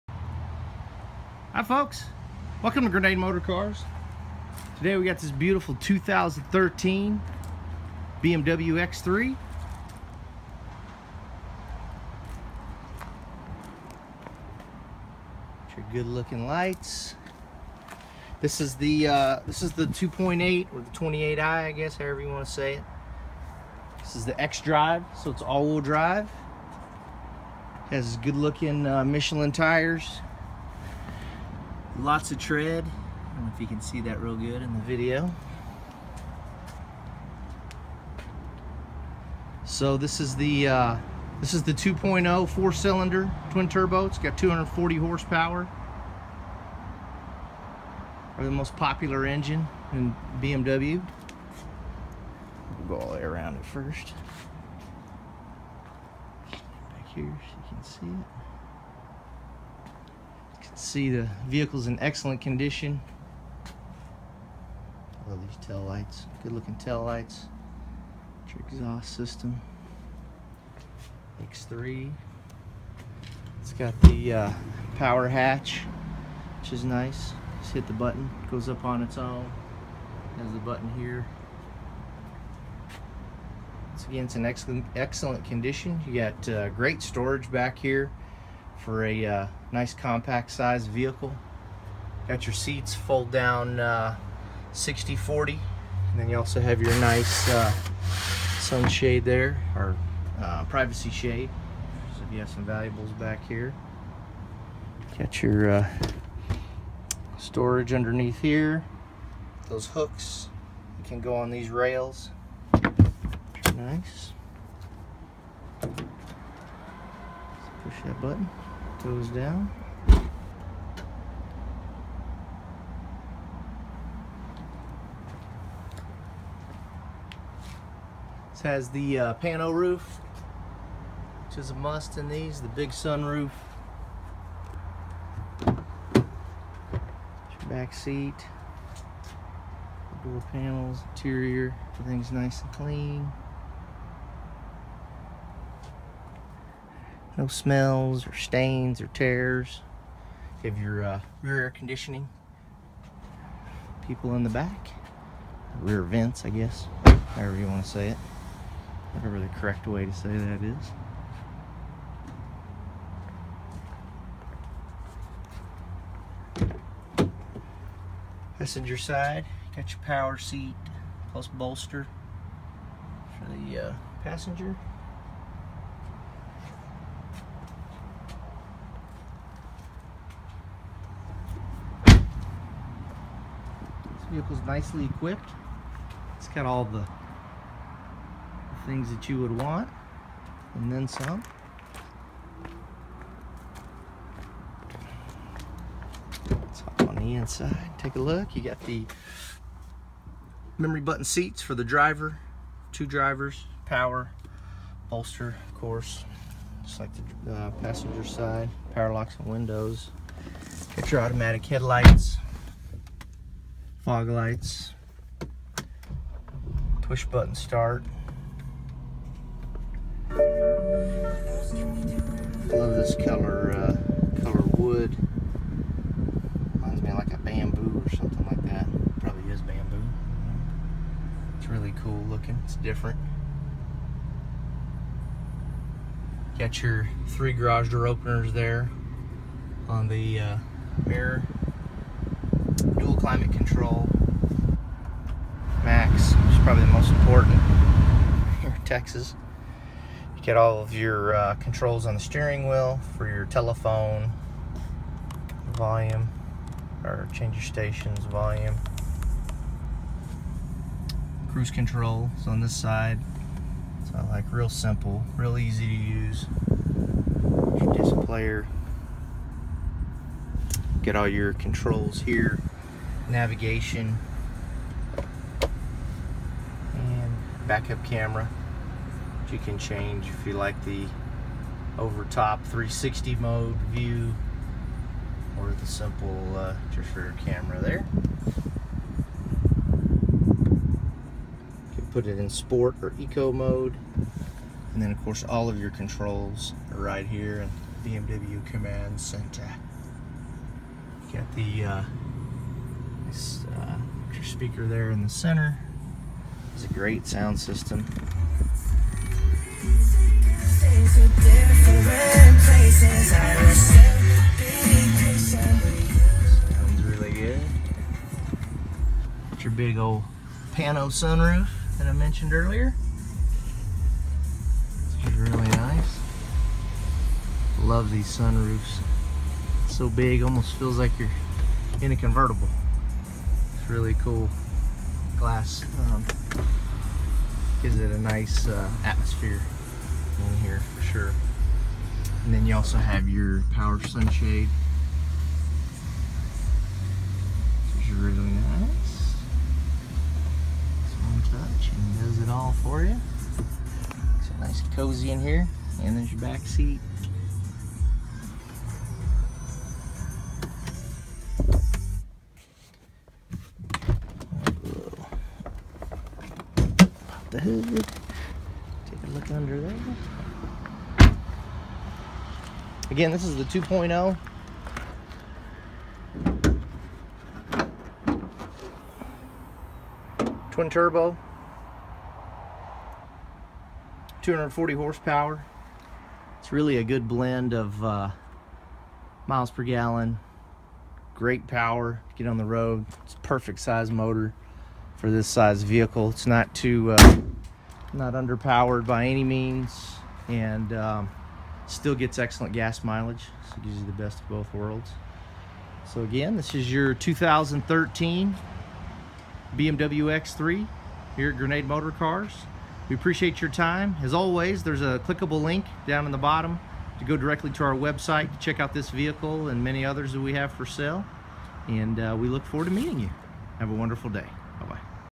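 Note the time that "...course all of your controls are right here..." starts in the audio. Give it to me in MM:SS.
04:55.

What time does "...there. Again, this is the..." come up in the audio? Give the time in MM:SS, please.
06:09.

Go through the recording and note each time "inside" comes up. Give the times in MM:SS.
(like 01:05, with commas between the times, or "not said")
03:17.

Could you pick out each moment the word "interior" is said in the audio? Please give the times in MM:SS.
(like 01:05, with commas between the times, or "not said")
02:21.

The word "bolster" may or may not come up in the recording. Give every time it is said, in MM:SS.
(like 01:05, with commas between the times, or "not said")
02:51, 03:25.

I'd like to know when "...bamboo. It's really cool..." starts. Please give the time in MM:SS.
03:49.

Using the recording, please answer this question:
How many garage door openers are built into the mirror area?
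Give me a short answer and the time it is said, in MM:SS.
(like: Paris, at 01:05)
3, at 03:57.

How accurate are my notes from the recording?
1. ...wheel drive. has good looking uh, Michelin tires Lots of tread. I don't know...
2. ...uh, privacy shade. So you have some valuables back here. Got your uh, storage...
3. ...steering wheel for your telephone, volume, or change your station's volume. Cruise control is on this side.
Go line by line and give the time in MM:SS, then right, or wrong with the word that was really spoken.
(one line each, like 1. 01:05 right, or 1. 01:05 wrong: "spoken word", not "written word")
1. 00:25 right
2. 01:40 right
3. 04:12 right.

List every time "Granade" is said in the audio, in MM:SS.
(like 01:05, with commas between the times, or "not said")
00:02, 06:51.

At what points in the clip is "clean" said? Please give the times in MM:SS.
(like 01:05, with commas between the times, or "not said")
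02:22.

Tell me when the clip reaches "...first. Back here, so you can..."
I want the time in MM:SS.
00:53.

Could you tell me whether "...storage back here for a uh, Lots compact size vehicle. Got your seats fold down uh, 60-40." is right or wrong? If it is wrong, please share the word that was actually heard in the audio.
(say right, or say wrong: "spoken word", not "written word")
wrong: "Nice", not "Lots".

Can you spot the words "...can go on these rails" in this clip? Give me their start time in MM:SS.
01:51.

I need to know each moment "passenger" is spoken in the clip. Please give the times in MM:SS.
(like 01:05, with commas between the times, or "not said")
02:48, 02:54, 03:27.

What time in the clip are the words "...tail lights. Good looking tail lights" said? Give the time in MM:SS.
01:05.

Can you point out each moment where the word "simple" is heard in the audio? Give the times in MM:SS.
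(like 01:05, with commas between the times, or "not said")
04:24, 04:45.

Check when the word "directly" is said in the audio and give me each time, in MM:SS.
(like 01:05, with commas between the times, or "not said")
06:57.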